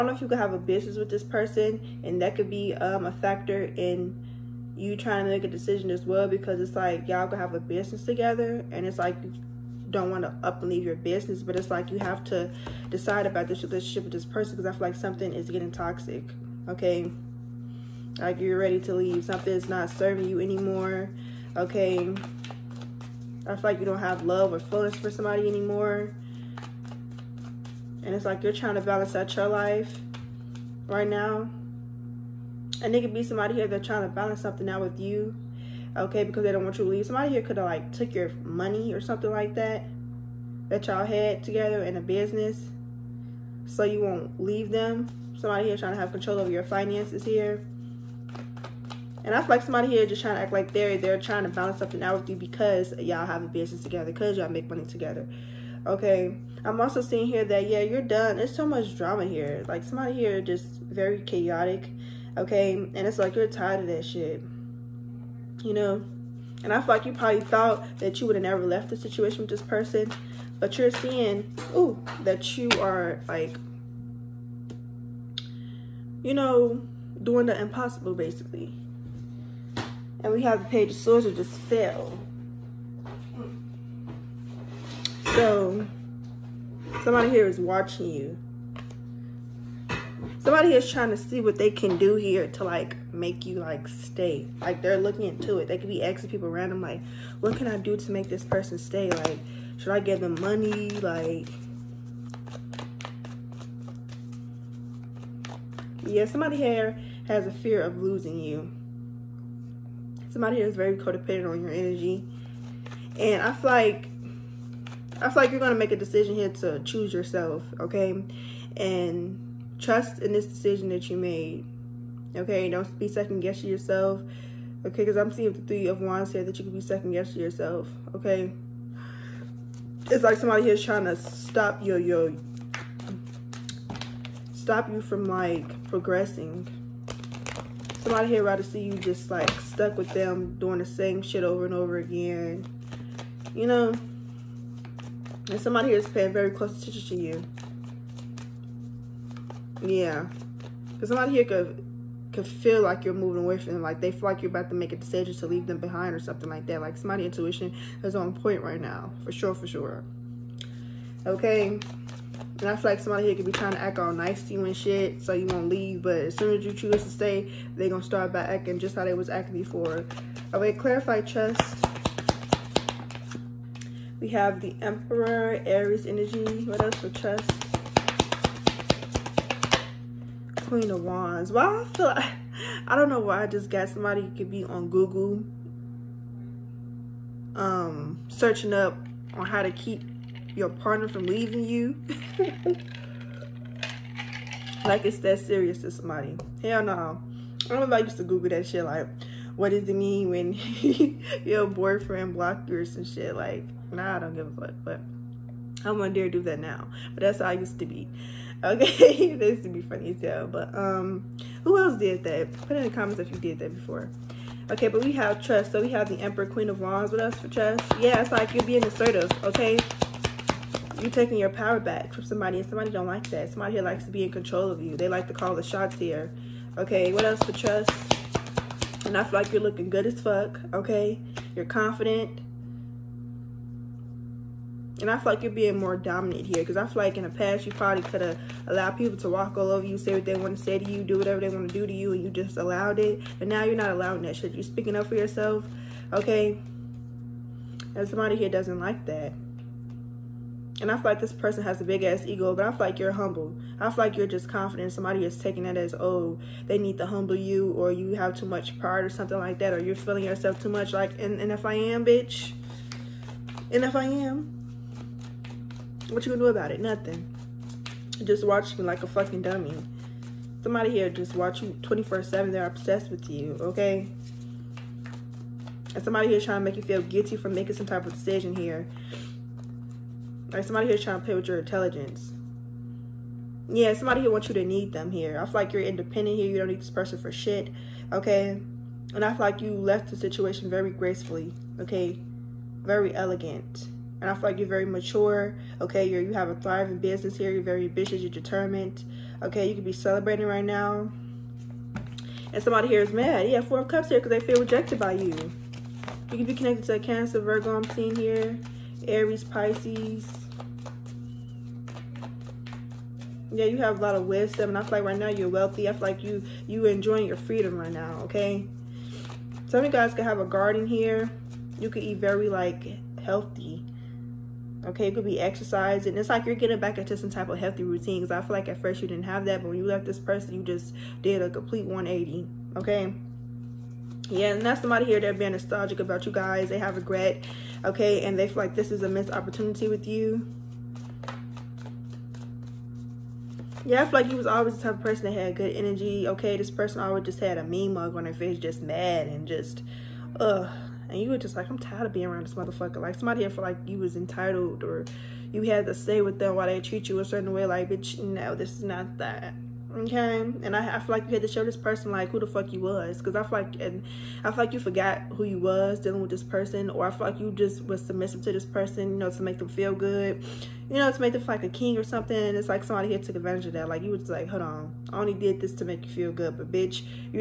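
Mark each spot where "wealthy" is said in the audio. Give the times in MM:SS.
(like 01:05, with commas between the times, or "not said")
05:15.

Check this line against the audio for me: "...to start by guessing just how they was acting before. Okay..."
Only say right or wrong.
wrong.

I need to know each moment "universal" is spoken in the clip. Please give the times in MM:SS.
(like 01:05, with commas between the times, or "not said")
not said.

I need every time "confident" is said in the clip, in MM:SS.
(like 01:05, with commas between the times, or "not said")
03:51, 04:14.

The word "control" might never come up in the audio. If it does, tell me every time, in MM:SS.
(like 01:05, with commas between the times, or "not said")
00:46, 03:44.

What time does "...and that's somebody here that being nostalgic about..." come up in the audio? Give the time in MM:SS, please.
05:34.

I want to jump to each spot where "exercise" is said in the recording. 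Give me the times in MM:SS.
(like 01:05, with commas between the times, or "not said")
05:25.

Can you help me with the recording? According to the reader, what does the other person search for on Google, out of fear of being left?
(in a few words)
How to keep your partner.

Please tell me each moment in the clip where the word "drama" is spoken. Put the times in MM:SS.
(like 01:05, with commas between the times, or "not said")
00:58.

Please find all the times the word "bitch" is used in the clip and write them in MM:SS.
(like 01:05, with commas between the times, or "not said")
04:22, 05:57, 06:16.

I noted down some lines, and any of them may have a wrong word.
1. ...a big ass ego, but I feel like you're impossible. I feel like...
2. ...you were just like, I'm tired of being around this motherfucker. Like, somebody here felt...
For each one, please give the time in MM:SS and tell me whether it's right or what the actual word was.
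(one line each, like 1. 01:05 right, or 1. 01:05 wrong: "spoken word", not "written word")
1. 04:11 wrong: "humble", not "impossible"
2. 05:51 right.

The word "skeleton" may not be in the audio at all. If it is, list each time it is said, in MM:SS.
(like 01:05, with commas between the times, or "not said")
not said.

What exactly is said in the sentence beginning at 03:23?
Like, nah, I don't give a fuck.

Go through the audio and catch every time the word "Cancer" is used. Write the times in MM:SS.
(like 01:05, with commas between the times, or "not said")
05:07.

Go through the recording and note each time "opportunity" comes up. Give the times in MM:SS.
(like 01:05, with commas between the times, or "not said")
05:39.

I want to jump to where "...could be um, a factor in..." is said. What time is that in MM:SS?
00:02.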